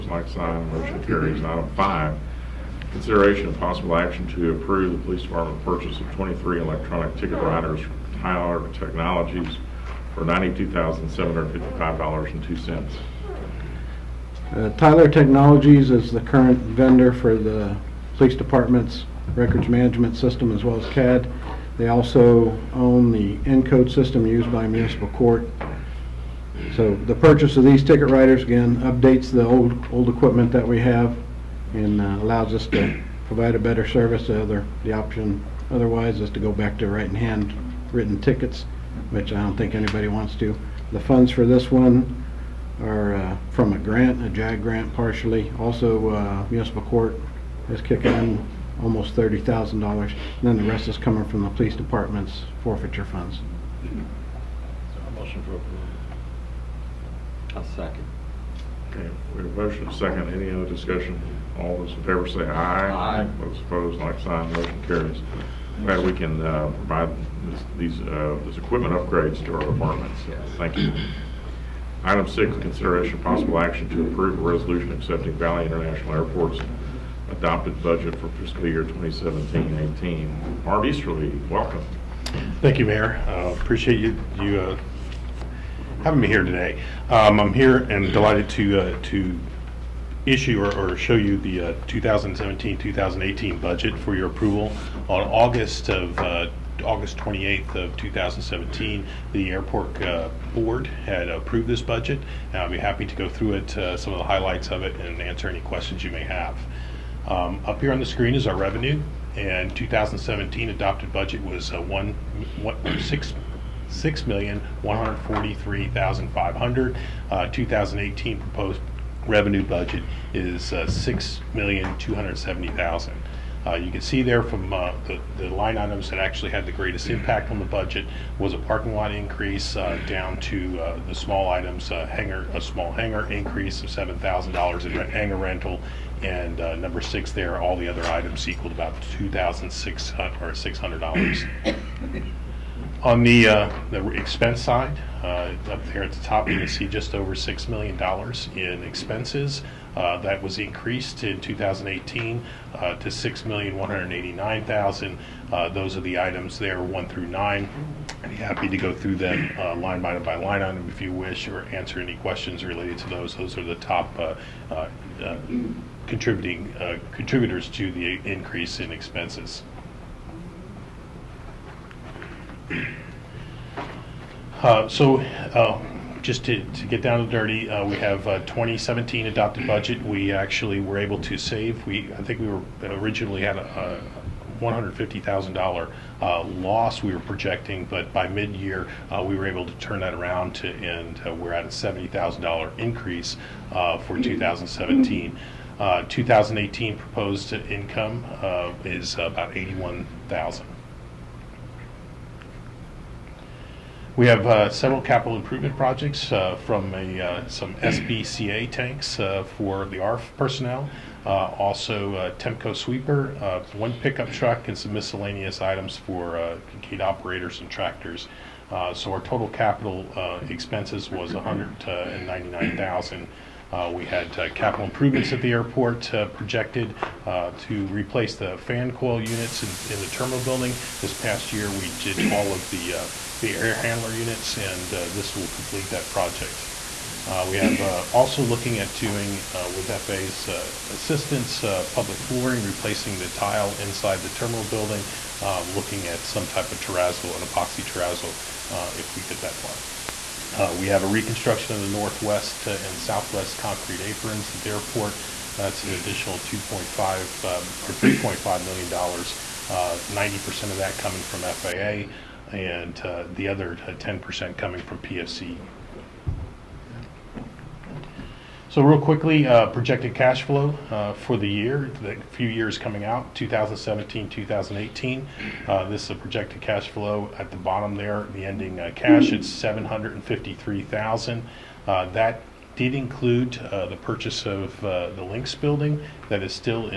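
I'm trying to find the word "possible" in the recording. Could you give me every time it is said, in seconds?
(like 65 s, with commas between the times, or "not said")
3 s, 73 s.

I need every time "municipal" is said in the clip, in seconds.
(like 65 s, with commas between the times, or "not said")
24 s, 46 s.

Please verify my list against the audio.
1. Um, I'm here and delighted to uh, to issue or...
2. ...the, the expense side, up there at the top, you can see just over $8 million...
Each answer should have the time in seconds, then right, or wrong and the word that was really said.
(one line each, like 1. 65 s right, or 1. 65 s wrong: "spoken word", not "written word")
1. 87 s right
2. 143 s wrong: "6", not "8".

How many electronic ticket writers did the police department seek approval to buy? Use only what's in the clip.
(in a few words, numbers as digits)
23.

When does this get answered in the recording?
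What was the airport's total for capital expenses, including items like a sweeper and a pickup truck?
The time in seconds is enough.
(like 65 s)
221 s.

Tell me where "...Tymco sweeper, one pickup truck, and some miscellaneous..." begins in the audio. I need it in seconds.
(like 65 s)
212 s.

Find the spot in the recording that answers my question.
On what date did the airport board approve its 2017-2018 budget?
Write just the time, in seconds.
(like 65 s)
96 s.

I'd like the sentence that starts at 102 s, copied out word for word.
And I'll be happy to go through it, uh, some of the highlights of it, and answer any questions you may have.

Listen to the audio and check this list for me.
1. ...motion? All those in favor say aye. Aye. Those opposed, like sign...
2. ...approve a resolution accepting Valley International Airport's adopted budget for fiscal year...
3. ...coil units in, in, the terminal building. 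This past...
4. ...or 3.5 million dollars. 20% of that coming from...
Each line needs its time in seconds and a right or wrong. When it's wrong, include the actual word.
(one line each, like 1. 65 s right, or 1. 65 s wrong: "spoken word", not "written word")
1. 60 s wrong: "discussion", not "motion"
2. 74 s right
3. 228 s right
4. 257 s wrong: "90", not "20".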